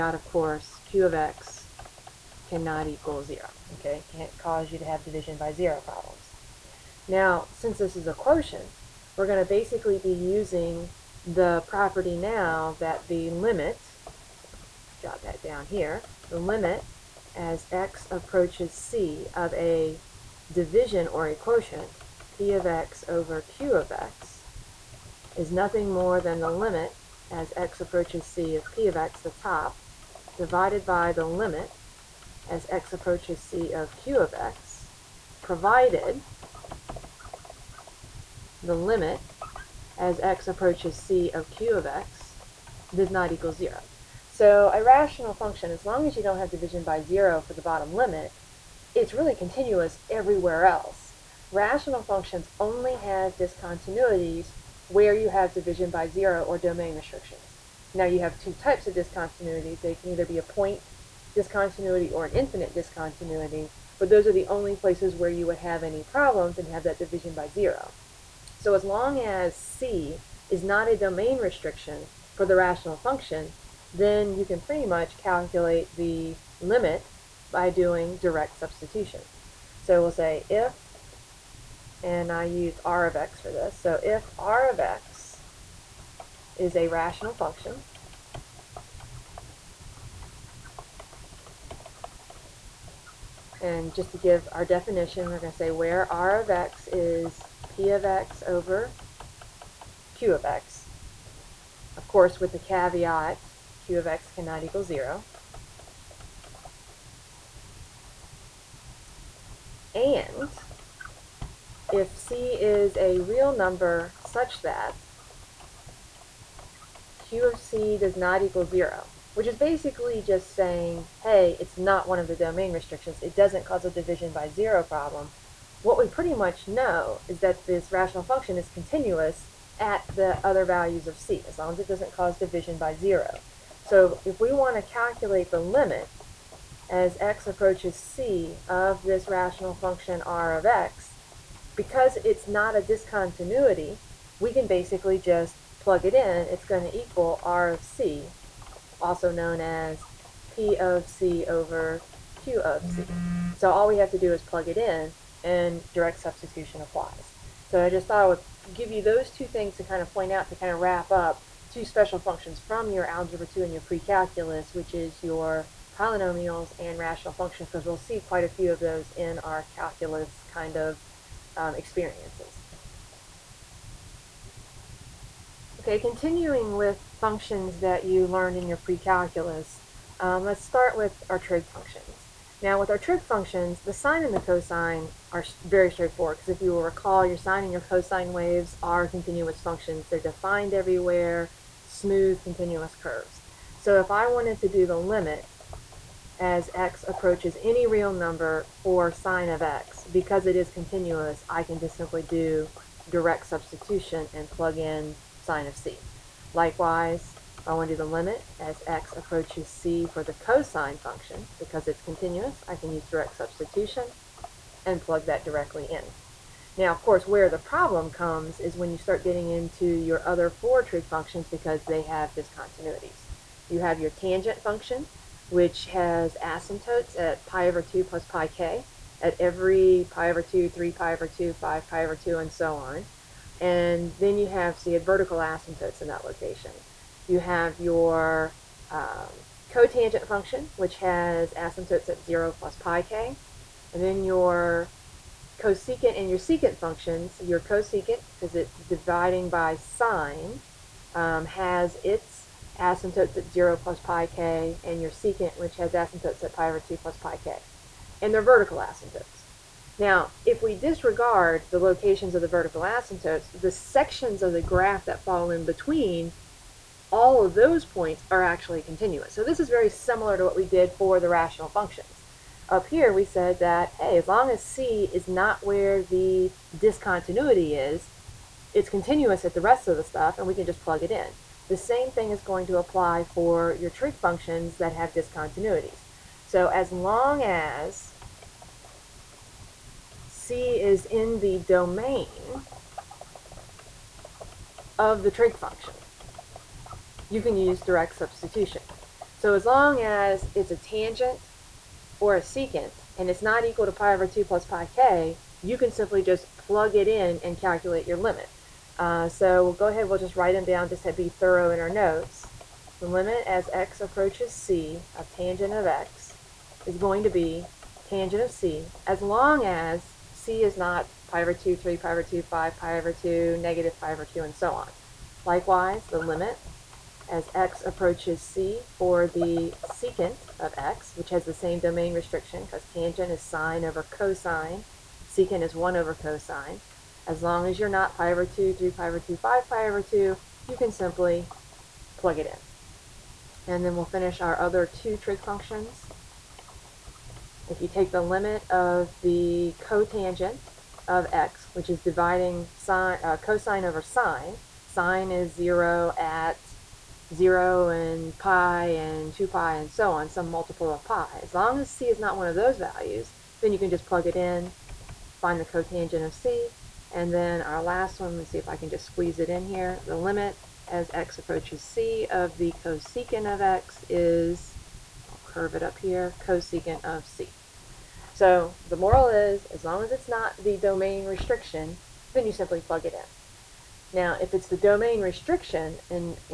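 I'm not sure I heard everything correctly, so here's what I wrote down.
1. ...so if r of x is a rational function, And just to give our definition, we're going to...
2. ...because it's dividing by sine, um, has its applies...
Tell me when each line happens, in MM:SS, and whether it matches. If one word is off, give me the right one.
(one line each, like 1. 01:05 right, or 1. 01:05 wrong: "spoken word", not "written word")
1. 01:23 right
2. 04:08 wrong: "asymptotes", not "applies".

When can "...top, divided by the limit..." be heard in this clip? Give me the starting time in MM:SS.
00:29.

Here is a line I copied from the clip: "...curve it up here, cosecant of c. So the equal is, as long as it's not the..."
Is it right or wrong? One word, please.
wrong.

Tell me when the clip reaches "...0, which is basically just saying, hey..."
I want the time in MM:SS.
01:58.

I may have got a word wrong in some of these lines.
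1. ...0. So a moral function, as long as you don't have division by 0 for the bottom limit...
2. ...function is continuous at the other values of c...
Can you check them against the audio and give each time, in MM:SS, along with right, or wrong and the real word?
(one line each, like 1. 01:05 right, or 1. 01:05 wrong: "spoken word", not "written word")
1. 00:43 wrong: "rational", not "moral"
2. 02:08 right.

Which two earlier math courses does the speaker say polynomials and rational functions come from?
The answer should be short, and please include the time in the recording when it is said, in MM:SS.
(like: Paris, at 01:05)
Algebra 2 and pre-calculus, at 02:43.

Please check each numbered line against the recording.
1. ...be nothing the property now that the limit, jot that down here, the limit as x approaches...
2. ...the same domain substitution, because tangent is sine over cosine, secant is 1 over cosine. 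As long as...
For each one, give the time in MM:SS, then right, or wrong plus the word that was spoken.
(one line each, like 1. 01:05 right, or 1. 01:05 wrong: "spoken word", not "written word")
1. 00:09 wrong: "using", not "nothing"
2. 05:31 wrong: "restriction", not "substitution".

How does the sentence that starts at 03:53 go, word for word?
And then you have, so you had vertical asymptotes in that location.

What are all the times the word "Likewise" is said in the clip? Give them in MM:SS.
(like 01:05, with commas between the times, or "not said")
03:26, 05:25.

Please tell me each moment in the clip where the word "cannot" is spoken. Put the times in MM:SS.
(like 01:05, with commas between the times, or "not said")
00:02, 01:44.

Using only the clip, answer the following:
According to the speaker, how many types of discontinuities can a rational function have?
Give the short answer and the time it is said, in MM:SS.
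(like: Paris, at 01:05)
2, at 00:58.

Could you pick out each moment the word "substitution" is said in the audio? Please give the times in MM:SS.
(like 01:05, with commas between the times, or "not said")
01:18, 02:36, 03:23, 03:33, 04:58.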